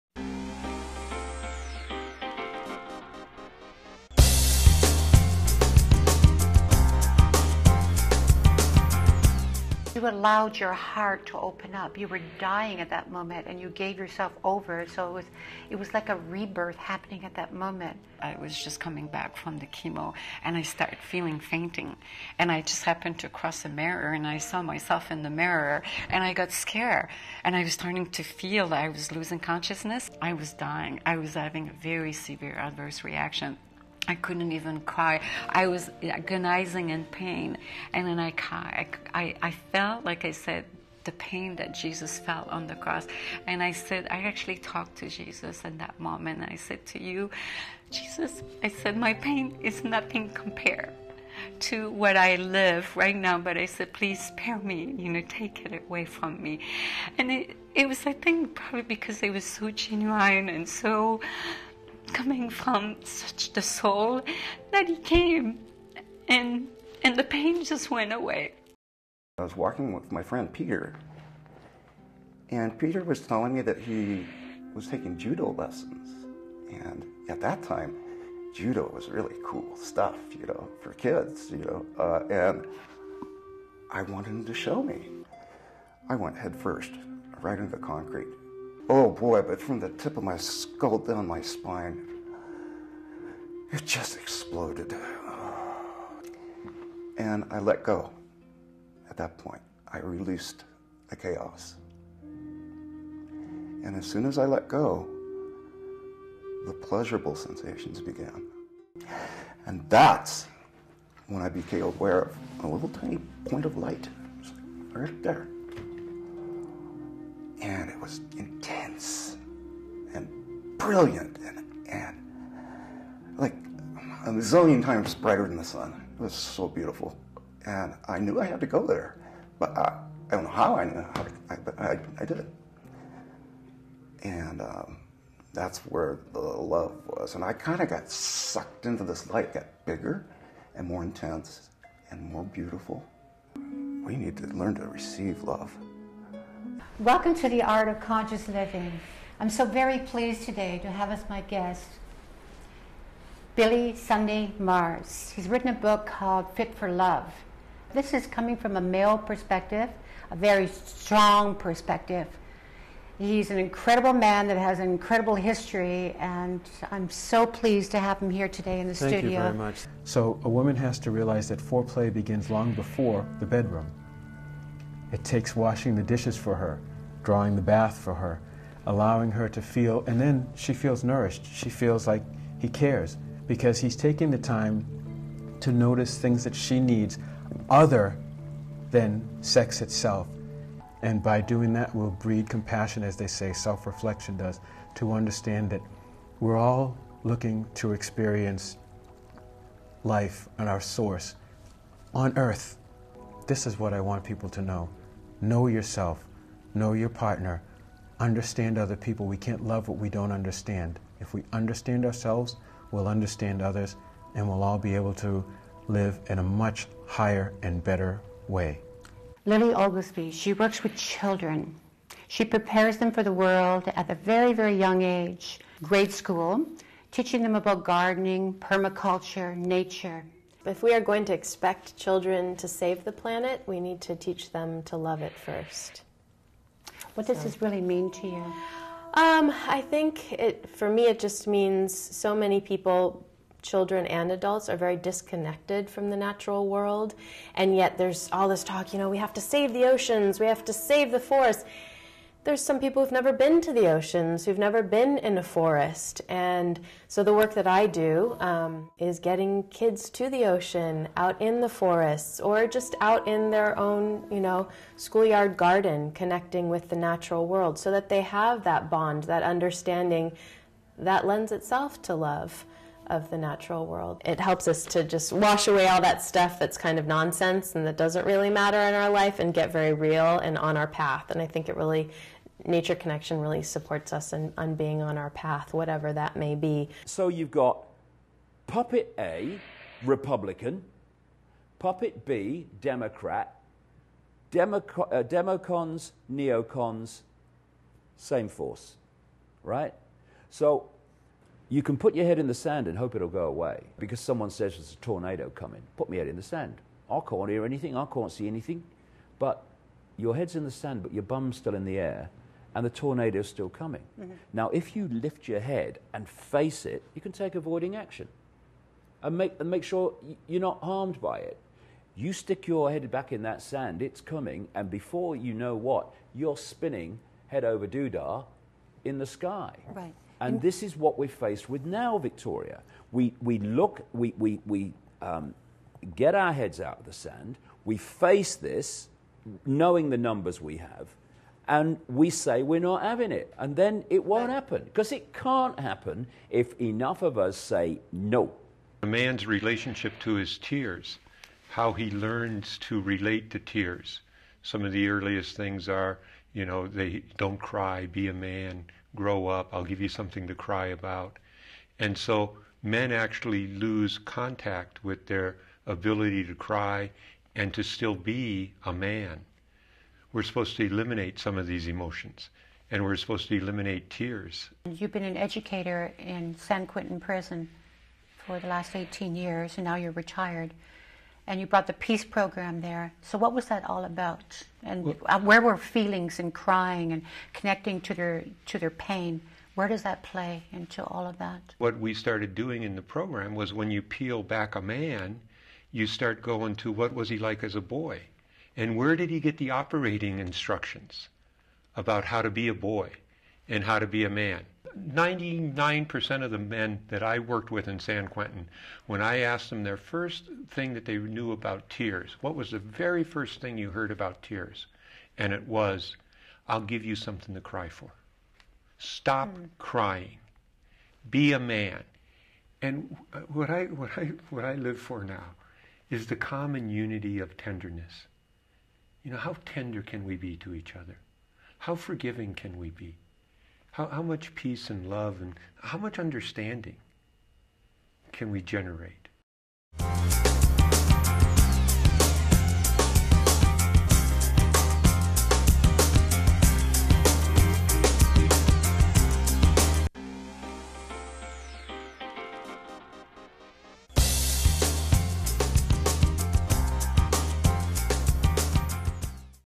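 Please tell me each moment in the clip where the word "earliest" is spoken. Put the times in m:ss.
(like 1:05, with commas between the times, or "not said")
5:55.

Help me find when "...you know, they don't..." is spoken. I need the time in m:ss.
5:56.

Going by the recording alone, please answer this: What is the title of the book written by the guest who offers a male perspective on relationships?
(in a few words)
Fit for Love.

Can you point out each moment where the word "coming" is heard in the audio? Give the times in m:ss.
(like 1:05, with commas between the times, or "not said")
0:18, 1:02, 2:38, 5:05, 5:13, 5:24.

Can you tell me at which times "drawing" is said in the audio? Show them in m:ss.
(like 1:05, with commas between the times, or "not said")
2:57.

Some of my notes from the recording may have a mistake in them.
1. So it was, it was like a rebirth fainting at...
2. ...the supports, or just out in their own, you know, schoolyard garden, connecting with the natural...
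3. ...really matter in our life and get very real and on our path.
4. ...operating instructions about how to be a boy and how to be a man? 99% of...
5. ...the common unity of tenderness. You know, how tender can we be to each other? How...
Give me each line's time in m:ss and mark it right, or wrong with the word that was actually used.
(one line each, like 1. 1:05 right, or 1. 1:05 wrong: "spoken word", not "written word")
1. 0:14 wrong: "happening", not "fainting"
2. 4:21 wrong: "forests", not "supports"
3. 4:38 right
4. 6:39 right
5. 7:06 right.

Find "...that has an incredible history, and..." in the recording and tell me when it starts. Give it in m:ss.
2:44.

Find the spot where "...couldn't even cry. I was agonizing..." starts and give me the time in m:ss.
0:34.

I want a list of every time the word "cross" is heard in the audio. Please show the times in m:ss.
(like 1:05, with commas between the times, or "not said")
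0:23, 0:42.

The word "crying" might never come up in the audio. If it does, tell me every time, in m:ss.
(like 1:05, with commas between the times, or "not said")
6:26, 6:59.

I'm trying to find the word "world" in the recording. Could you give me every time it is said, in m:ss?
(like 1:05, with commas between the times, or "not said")
3:43, 4:06, 4:27, 4:33.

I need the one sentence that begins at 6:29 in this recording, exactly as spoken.
Where does that play into all of that?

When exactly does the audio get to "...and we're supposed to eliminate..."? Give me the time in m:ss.
6:12.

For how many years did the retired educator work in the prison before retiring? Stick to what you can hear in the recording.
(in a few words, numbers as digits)
18.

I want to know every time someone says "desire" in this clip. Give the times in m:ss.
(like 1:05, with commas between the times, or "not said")
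not said.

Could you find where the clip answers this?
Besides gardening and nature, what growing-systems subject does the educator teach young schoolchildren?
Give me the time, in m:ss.
3:48.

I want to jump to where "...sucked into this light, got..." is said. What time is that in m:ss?
2:18.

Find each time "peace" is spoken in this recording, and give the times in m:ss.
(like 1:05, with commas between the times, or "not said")
6:21, 7:14.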